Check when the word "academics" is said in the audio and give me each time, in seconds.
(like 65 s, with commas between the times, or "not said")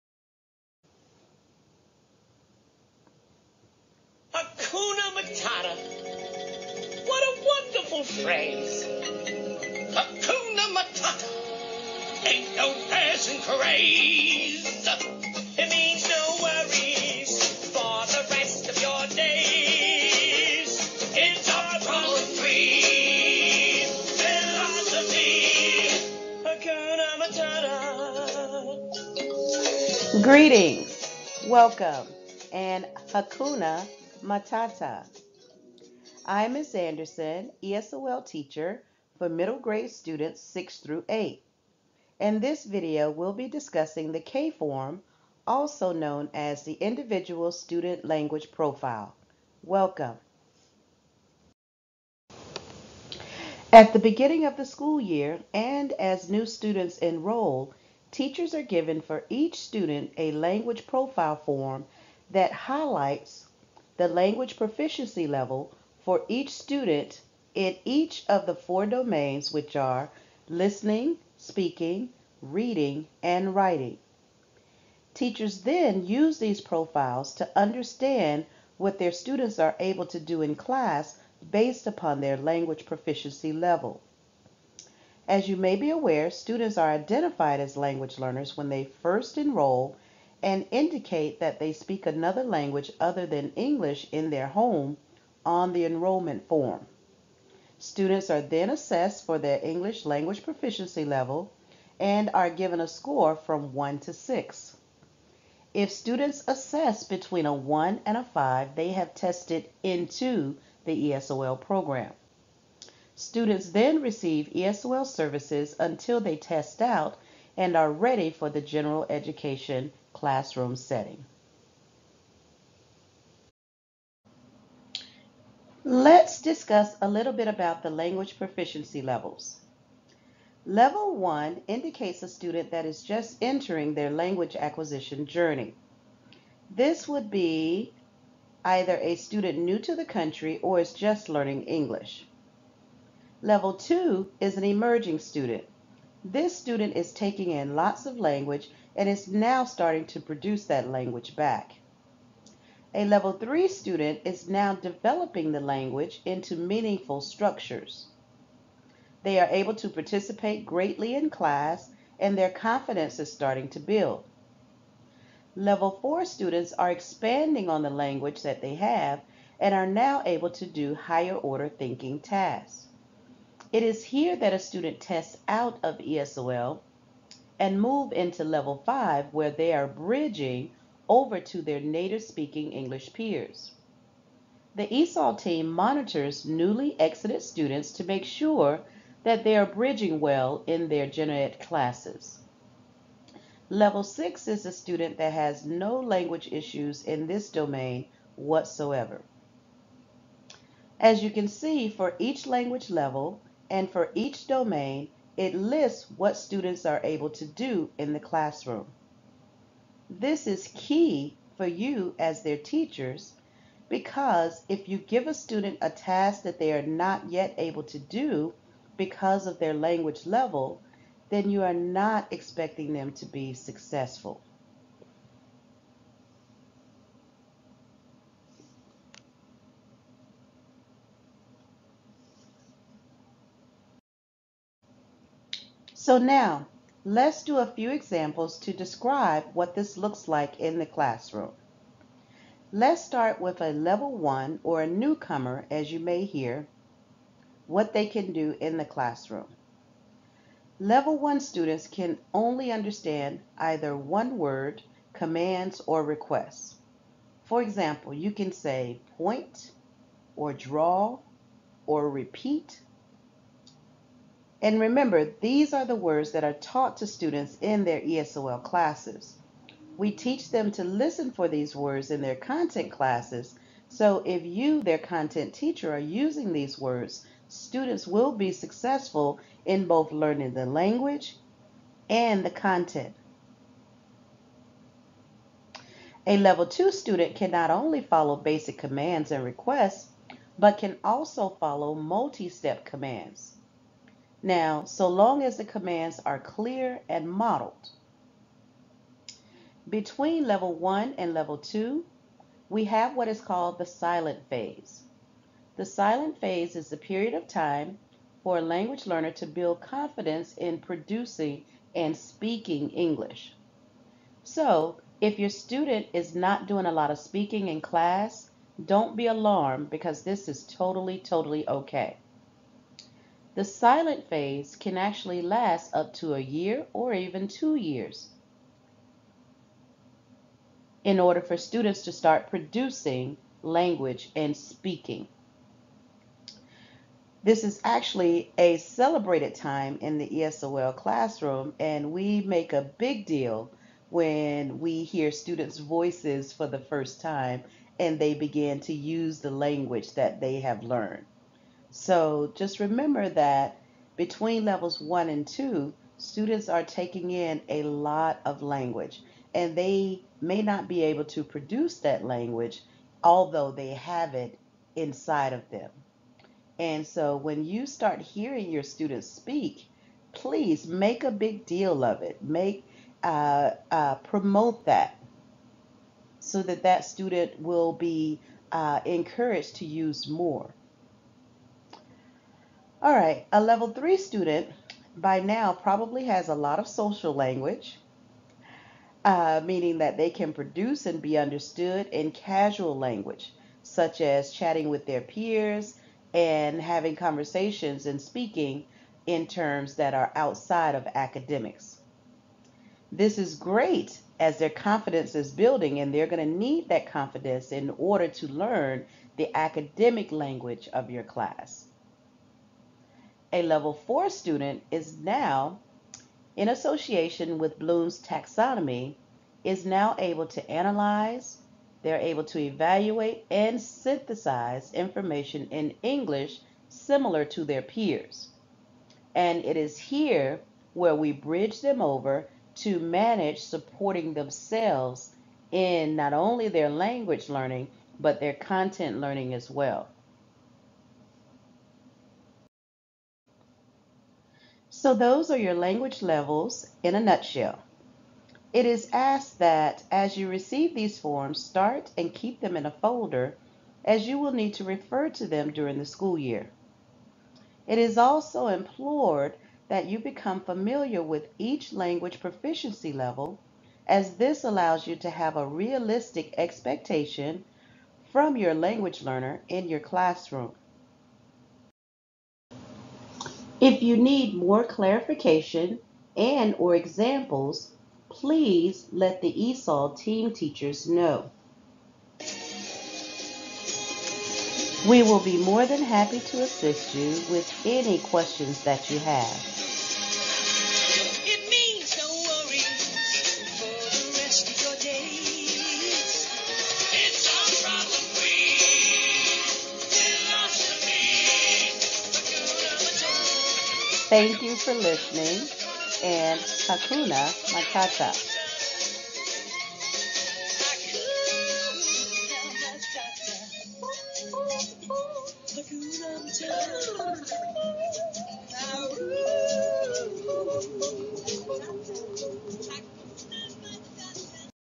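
401 s, 409 s.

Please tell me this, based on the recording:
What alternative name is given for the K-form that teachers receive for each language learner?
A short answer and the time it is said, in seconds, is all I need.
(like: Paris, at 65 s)
Individual Student Language Profile, at 46 s.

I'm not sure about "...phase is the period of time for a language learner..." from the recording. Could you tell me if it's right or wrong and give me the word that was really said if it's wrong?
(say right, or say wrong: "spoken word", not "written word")
right.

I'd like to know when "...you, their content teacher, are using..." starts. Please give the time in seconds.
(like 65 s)
274 s.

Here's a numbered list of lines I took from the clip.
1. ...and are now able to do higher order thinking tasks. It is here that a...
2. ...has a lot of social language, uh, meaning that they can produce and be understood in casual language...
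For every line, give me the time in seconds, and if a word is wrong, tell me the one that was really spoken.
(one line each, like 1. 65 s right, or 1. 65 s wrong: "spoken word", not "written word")
1. 169 s right
2. 386 s right.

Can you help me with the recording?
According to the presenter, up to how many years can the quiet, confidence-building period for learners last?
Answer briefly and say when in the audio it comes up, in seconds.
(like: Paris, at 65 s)
2 years, at 327 s.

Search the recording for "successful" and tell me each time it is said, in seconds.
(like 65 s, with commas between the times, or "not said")
223 s, 278 s.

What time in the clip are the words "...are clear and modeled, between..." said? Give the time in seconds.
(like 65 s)
296 s.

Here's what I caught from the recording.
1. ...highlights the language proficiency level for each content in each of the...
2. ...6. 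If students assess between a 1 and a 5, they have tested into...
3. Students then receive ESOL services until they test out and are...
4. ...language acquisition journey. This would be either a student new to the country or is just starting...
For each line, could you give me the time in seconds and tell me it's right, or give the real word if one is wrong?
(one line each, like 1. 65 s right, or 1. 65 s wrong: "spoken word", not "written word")
1. 62 s wrong: "student", not "content"
2. 104 s right
3. 113 s right
4. 134 s wrong: "learning", not "starting".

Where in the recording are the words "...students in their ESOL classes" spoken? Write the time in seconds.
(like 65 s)
267 s.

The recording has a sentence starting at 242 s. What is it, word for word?
Let's start with a level one or a newcomer, as you may hear, what they can do in the classroom.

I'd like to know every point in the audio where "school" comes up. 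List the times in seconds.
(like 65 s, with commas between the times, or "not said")
54 s, 456 s.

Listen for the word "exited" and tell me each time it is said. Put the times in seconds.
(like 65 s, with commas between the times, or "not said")
187 s.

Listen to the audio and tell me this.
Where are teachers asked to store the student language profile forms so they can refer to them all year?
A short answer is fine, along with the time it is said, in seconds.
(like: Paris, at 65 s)
a folder, at 452 s.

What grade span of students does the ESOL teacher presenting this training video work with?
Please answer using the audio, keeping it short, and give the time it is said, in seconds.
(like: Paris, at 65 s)
6 through 8, at 40 s.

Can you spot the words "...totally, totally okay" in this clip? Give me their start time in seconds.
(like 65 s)
320 s.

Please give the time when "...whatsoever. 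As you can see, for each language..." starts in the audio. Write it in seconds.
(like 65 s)
198 s.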